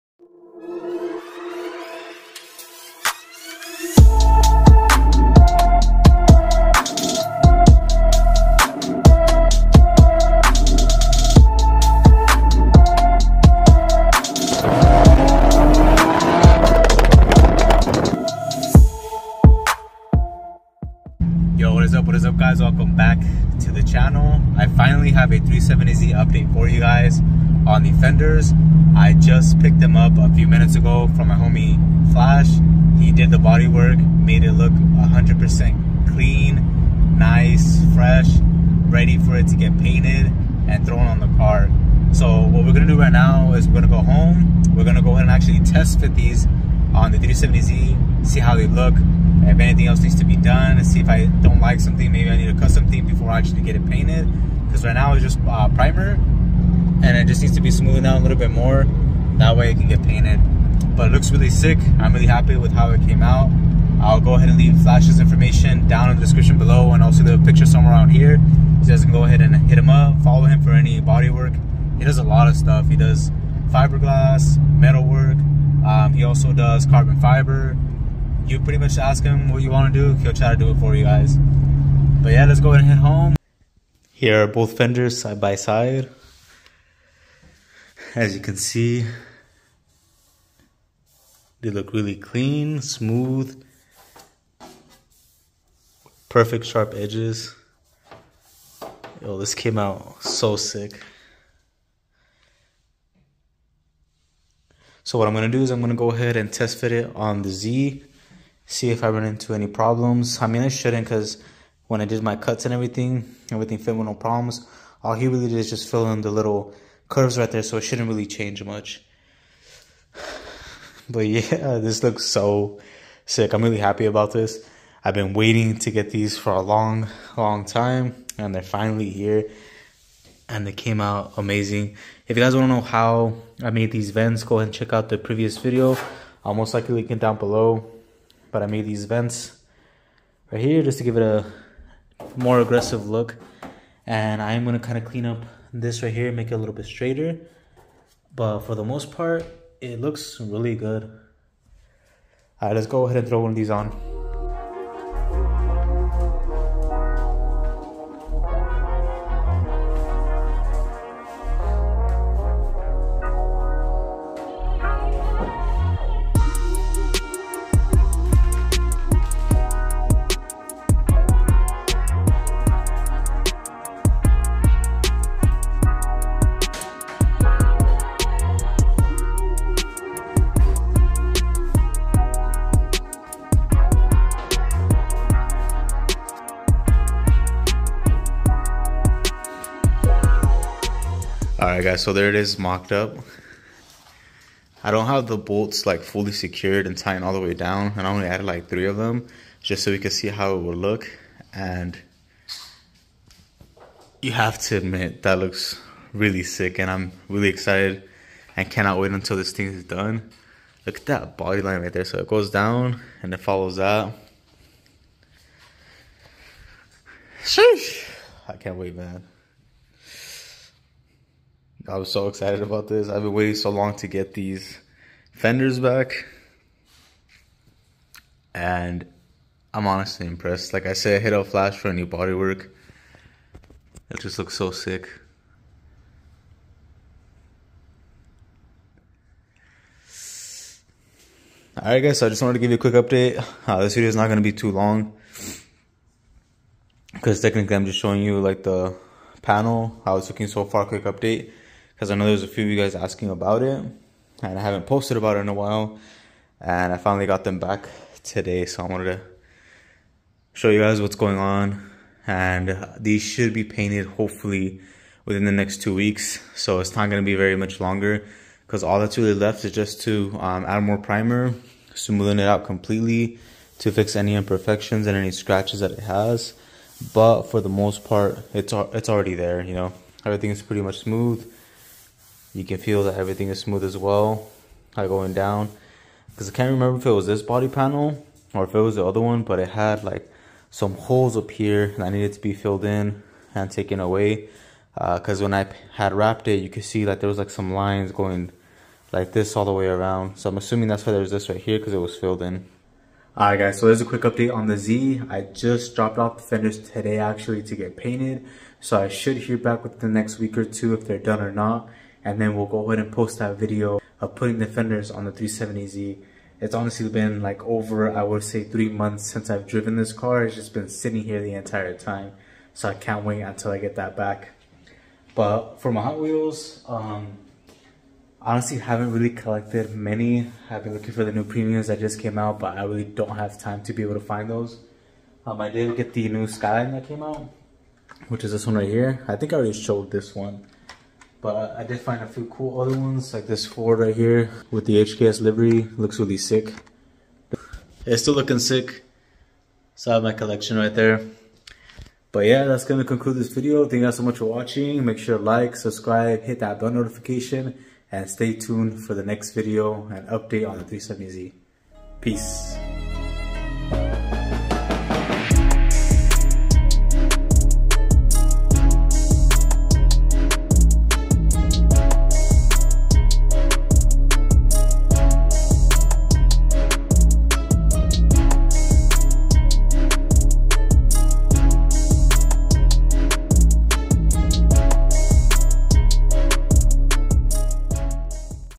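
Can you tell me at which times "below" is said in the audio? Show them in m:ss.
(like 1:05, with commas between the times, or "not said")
1:06, 2:17.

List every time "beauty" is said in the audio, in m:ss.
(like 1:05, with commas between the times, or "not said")
not said.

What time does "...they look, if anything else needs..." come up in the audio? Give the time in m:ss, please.
0:48.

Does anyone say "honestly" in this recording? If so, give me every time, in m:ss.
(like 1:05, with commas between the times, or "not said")
3:49, 5:16, 5:28.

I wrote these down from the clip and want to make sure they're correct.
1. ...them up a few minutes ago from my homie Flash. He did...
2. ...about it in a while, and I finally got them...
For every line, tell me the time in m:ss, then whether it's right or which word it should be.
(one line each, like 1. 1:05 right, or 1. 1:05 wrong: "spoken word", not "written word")
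1. 0:29 right
2. 4:15 right.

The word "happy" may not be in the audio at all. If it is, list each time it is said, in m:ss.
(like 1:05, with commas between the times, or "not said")
1:02, 2:03.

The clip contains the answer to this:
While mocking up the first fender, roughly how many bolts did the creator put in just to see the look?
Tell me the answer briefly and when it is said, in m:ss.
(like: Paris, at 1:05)
3, at 3:18.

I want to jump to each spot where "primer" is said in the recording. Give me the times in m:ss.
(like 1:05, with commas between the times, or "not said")
0:55, 4:30.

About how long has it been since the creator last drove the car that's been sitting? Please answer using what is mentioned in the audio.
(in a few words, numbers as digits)
over 3 months.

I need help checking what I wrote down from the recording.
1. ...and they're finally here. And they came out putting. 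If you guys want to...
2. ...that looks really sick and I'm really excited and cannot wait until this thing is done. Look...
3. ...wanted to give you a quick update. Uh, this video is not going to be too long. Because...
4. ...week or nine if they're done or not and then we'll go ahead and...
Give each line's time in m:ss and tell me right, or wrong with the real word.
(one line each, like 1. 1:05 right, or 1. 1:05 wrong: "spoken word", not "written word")
1. 2:08 wrong: "amazing", not "putting"
2. 3:25 right
3. 4:02 right
4. 5:10 wrong: "two", not "nine".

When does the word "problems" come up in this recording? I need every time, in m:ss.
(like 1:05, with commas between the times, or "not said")
1:49, 1:54.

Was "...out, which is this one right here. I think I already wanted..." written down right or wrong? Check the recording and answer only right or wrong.
wrong.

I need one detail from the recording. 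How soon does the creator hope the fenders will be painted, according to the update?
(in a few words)
within the next two weeks.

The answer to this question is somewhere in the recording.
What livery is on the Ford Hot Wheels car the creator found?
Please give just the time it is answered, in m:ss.
5:45.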